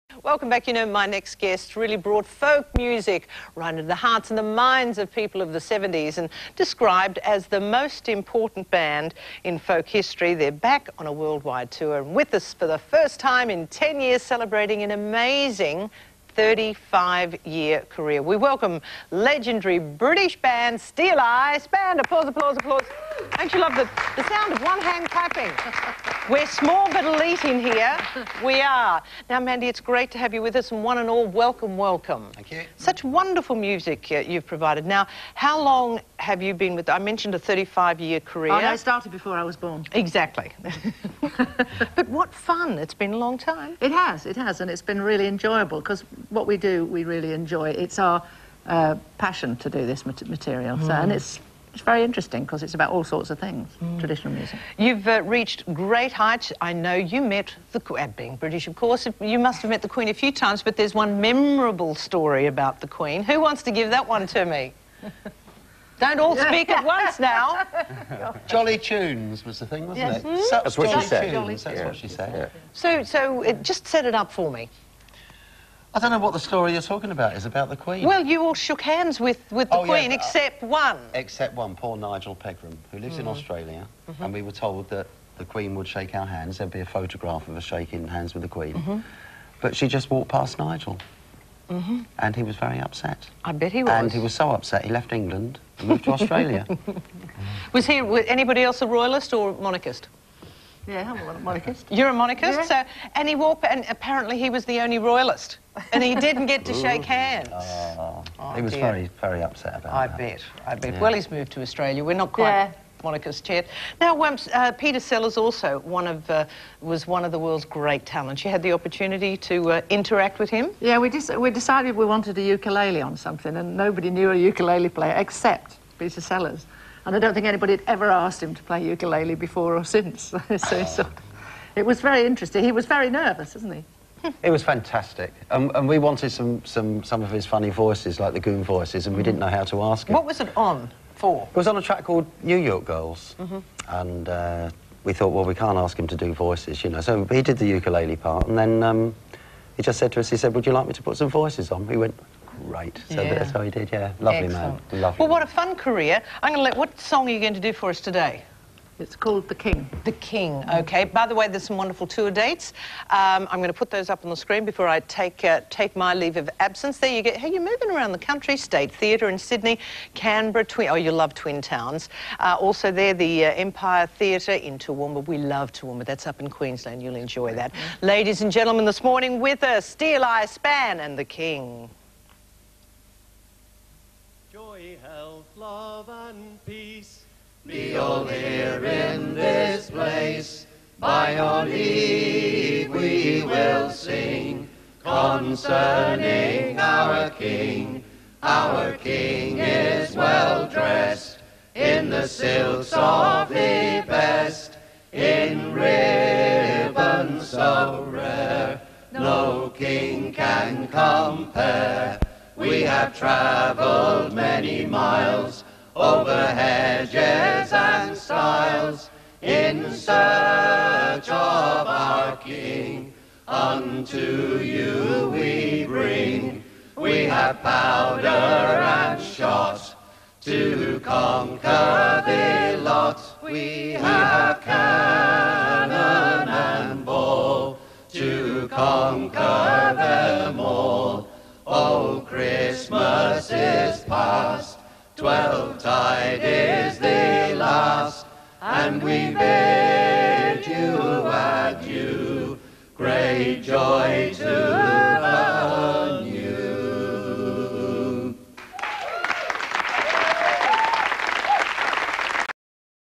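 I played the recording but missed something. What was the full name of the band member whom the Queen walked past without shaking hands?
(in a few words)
Nigel Pegram.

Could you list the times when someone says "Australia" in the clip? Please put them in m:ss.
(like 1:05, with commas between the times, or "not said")
1:23, 1:36, 1:51.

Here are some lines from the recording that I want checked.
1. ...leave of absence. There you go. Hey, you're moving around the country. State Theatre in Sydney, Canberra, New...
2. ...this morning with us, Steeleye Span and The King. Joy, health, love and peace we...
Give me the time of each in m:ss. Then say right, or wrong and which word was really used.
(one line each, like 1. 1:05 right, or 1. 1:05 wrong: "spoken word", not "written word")
1. 2:46 wrong: "Twin", not "New"
2. 2:58 right.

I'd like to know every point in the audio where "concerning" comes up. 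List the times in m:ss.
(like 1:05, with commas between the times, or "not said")
3:15.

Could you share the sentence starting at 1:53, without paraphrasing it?
Now, uh, Peter Sellers also one of uh, was one of the world's great talents.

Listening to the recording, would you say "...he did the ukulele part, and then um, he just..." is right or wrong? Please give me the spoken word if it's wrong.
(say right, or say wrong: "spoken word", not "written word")
right.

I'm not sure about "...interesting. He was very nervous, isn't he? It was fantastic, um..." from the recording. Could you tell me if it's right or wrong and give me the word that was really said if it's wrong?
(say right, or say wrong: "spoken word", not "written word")
right.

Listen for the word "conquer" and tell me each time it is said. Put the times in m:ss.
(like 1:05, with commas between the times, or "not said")
3:51, 3:58.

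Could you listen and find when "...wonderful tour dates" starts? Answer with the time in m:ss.
2:41.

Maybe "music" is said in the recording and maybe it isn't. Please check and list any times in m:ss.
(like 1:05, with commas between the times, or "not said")
0:02, 0:33, 0:54.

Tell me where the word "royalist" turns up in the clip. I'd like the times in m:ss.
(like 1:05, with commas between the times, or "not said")
1:38, 1:44.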